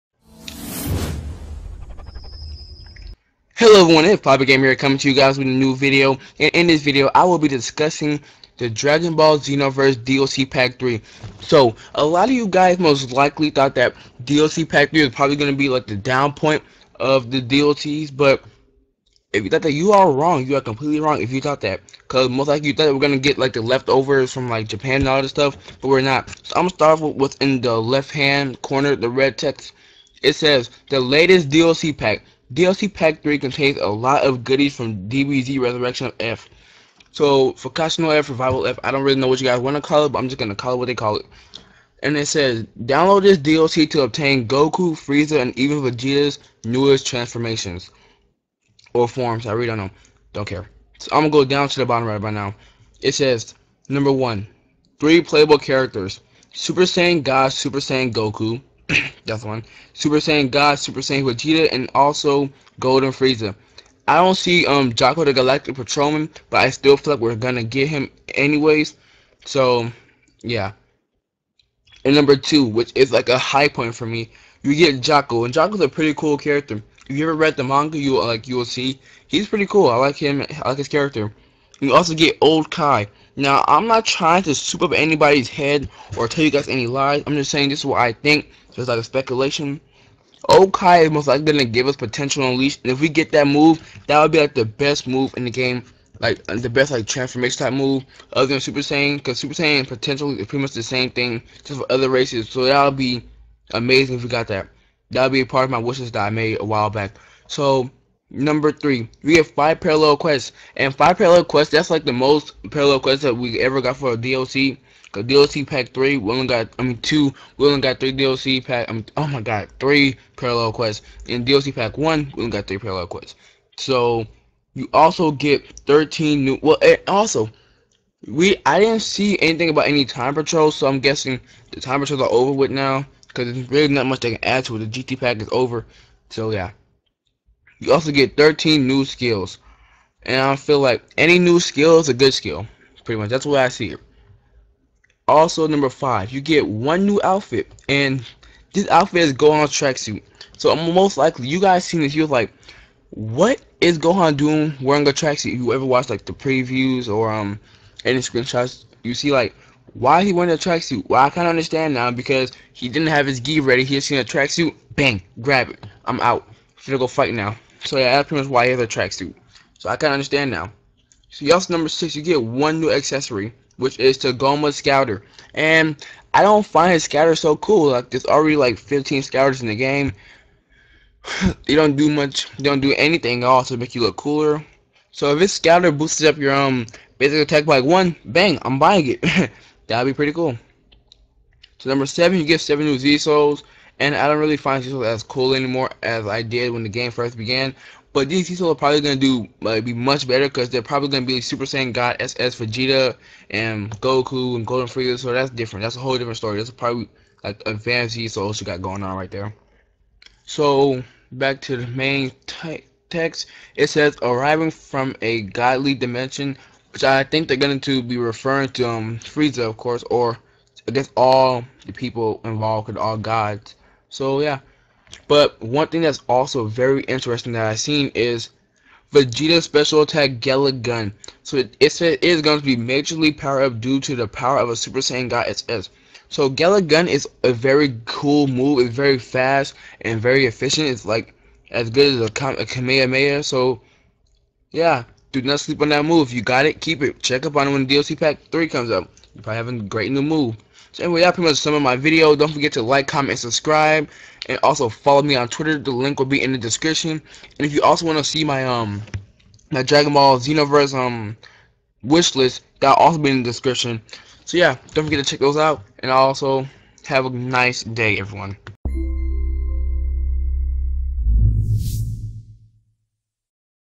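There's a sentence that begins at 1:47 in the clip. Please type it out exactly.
So number three, we have five parallel quests, and five parallel quests.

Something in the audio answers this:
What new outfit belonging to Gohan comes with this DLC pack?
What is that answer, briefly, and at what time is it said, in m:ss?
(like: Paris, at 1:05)
Gohan's tracksuit, at 2:29.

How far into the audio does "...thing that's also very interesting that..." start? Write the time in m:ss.
3:45.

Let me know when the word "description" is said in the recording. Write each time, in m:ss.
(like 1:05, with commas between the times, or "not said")
4:16, 4:23.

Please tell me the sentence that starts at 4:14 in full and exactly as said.
And also follow me on Twitter.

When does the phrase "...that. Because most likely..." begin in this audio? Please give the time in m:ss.
0:21.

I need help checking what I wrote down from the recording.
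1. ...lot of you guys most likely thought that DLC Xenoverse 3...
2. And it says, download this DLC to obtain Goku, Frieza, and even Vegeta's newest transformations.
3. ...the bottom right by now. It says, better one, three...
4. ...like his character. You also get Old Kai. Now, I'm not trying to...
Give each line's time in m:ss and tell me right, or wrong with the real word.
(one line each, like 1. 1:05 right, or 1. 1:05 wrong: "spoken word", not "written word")
1. 0:12 wrong: "Pack", not "Xenoverse"
2. 0:42 right
3. 0:51 wrong: "number", not "better"
4. 1:20 right.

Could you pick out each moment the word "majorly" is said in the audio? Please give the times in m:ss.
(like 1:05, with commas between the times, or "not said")
3:52.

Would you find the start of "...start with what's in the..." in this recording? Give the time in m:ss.
0:26.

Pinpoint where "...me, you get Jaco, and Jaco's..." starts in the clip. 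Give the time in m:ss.
1:14.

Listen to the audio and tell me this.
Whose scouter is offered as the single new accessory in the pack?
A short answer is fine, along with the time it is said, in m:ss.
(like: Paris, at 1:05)
Tagoma, at 2:54.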